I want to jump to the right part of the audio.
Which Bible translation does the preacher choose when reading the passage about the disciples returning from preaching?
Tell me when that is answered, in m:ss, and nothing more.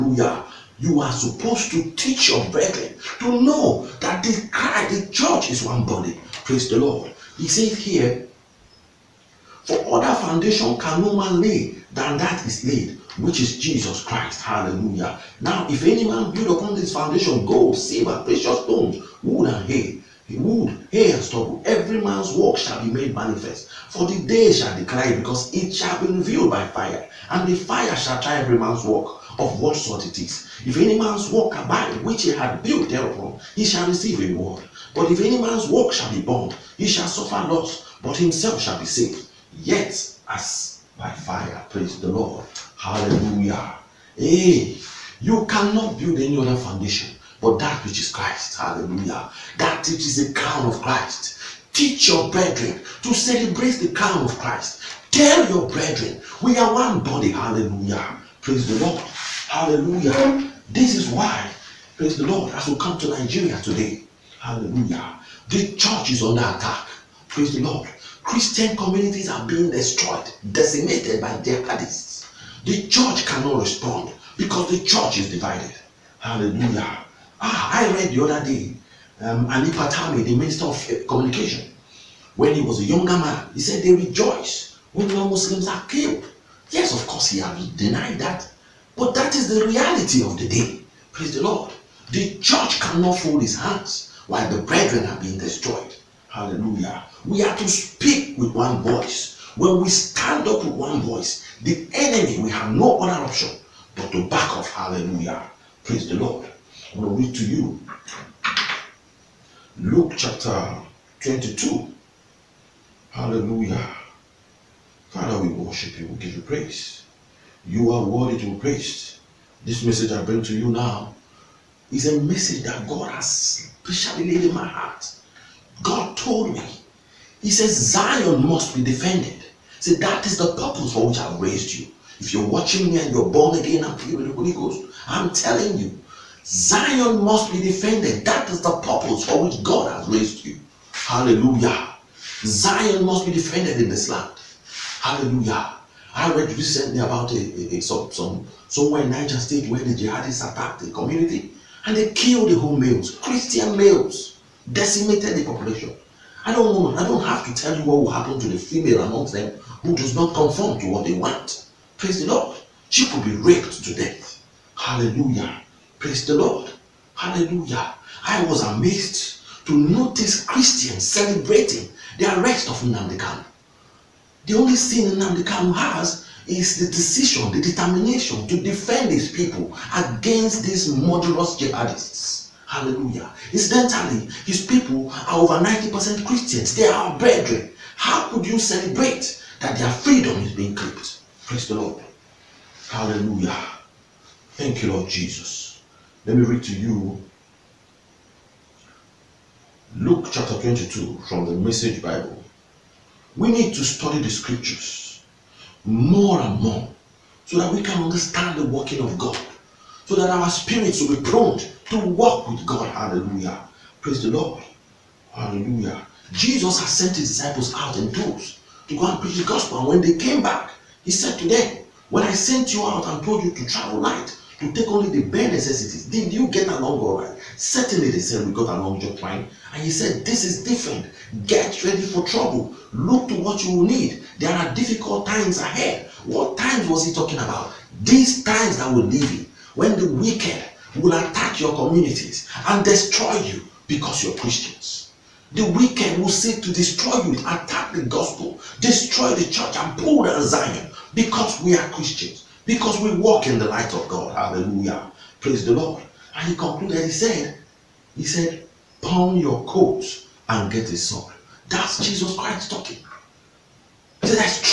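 3:21.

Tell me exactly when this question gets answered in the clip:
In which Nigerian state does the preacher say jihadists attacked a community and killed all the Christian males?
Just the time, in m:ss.
2:29.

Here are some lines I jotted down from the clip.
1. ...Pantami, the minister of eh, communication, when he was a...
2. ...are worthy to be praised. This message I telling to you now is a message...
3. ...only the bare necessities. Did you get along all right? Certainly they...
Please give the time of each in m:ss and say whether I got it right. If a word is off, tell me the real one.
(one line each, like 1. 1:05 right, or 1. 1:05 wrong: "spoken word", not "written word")
1. 1:19 right
2. 1:57 wrong: "bring", not "telling"
3. 3:44 right.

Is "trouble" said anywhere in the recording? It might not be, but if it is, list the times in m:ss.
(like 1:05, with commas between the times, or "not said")
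3:52.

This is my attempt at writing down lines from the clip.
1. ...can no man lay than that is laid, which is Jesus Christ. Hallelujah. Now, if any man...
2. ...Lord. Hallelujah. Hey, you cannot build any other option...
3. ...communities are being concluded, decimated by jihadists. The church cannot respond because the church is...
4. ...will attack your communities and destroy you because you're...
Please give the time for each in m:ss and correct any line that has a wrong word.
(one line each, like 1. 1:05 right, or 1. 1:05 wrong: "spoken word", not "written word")
1. 0:10 right
2. 0:42 wrong: "foundation", not "option"
3. 1:08 wrong: "destroyed", not "concluded"
4. 4:01 right.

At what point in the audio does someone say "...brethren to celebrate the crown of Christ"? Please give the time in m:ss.
0:52.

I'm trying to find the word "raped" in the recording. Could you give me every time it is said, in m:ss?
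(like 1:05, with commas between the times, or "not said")
2:43.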